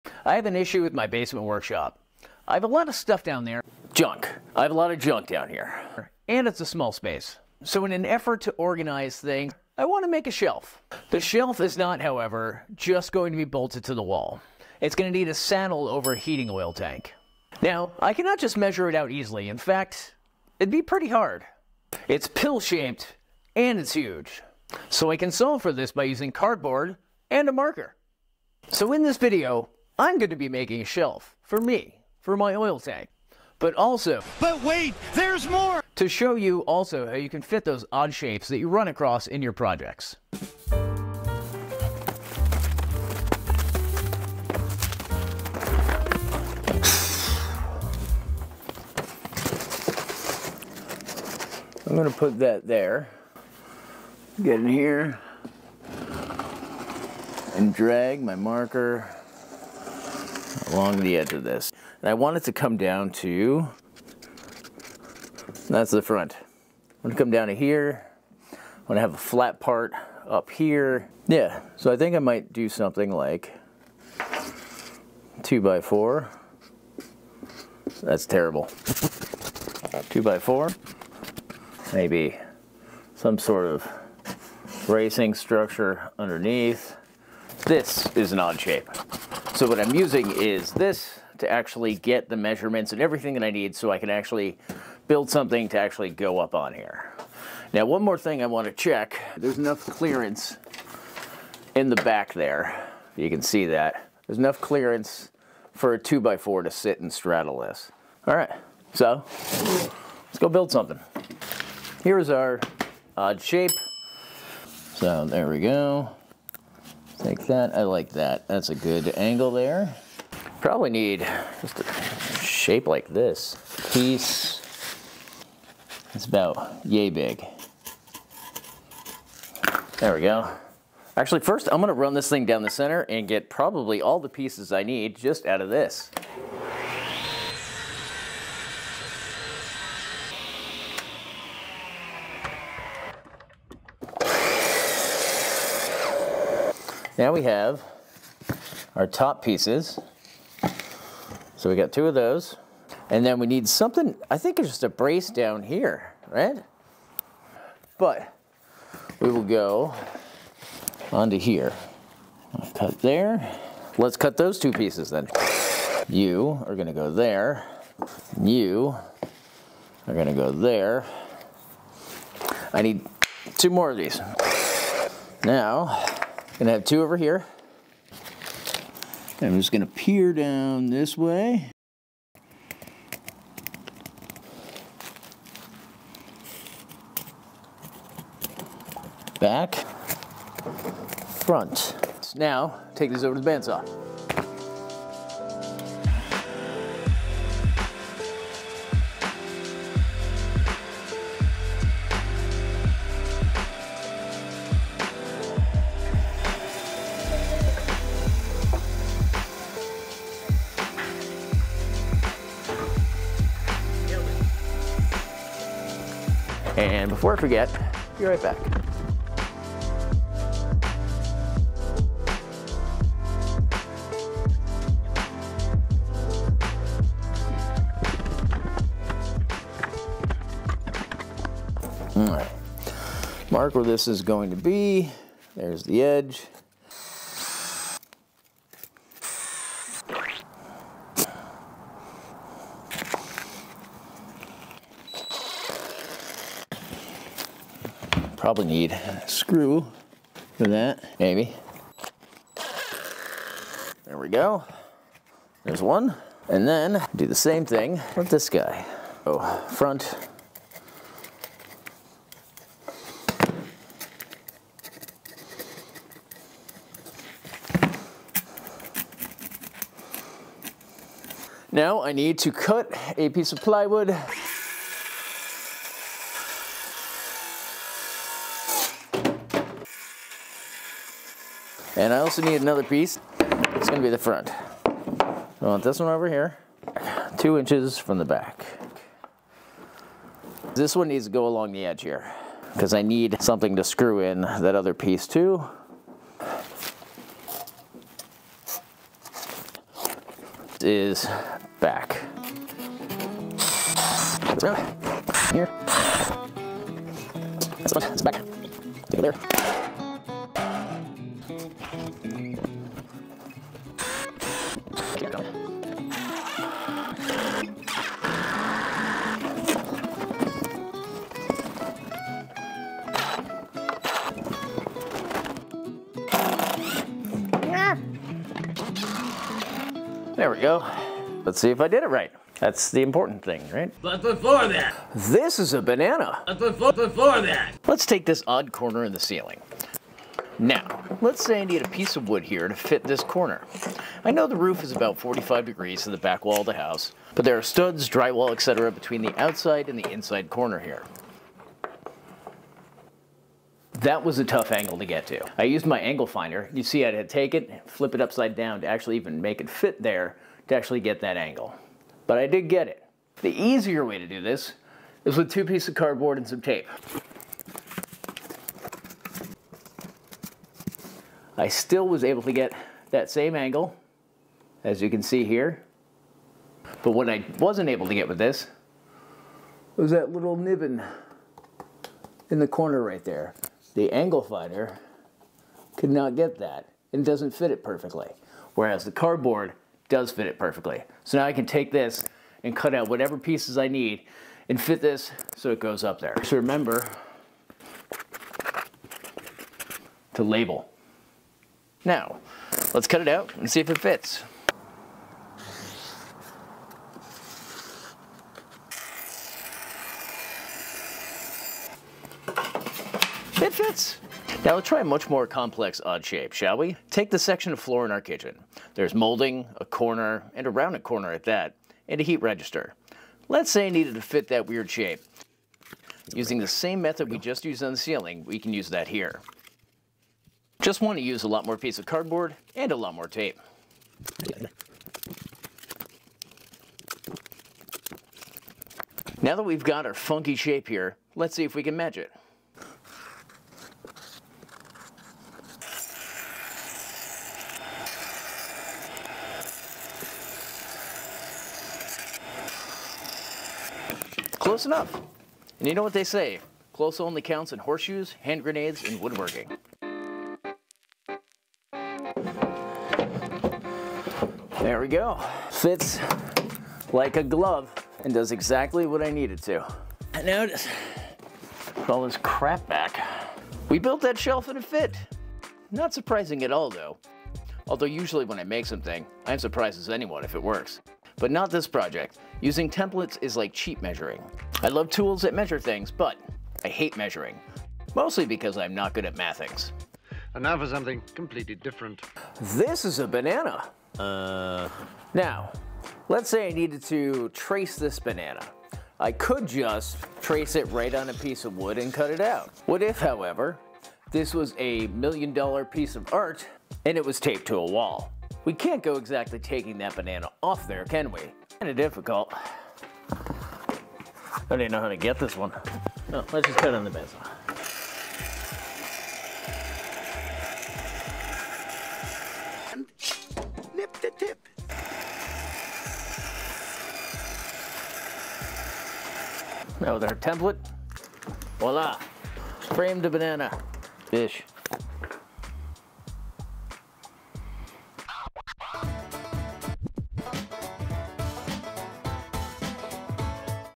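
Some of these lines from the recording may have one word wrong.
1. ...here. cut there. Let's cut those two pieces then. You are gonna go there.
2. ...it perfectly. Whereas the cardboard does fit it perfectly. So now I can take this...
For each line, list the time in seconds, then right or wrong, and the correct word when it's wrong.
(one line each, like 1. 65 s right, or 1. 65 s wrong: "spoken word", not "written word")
1. 161 s right
2. 387 s right.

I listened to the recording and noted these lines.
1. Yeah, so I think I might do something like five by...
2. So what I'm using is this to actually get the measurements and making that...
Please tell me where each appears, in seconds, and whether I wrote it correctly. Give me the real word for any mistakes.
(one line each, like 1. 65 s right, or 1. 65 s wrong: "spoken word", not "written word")
1. 71 s wrong: "two", not "five"
2. 89 s wrong: "everything", not "making".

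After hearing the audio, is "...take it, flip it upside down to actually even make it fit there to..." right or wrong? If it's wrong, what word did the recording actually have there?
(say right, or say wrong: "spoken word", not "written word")
right.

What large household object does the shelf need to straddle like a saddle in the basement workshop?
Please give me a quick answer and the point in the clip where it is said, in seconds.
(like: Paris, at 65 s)
heating oil tank, at 16 s.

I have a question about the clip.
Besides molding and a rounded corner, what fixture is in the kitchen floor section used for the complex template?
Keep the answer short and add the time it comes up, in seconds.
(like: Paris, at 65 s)
heat register, at 422 s.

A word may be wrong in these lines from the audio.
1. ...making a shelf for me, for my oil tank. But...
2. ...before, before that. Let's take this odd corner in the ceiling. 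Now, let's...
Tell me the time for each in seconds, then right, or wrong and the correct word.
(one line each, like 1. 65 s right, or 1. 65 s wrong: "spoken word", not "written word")
1. 30 s right
2. 336 s right.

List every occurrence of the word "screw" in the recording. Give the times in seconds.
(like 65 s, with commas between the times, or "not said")
249 s, 293 s.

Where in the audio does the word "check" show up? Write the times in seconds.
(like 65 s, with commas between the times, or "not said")
98 s.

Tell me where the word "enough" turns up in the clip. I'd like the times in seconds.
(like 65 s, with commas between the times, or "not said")
99 s, 104 s, 454 s.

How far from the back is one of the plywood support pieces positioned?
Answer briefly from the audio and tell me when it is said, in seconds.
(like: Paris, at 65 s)
2 inches, at 287 s.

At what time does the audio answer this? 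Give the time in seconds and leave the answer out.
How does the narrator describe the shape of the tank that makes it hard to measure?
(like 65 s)
22 s.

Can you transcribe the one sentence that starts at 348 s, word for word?
between the outside and the inside corner here.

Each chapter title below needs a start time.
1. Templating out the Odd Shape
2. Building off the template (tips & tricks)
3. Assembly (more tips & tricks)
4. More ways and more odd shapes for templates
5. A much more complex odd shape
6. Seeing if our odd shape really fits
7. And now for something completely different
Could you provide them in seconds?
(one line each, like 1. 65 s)
1. 47 s
2. 111 s
3. 232 s
4. 338 s
5. 414 s
6. 460 s
7. 490 s.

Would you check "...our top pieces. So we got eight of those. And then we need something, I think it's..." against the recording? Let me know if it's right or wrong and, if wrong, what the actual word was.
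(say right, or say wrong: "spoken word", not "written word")
wrong: "two", not "eight".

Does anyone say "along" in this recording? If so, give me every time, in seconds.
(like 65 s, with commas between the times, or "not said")
60 s, 291 s.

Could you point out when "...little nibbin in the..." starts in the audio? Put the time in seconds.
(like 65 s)
380 s.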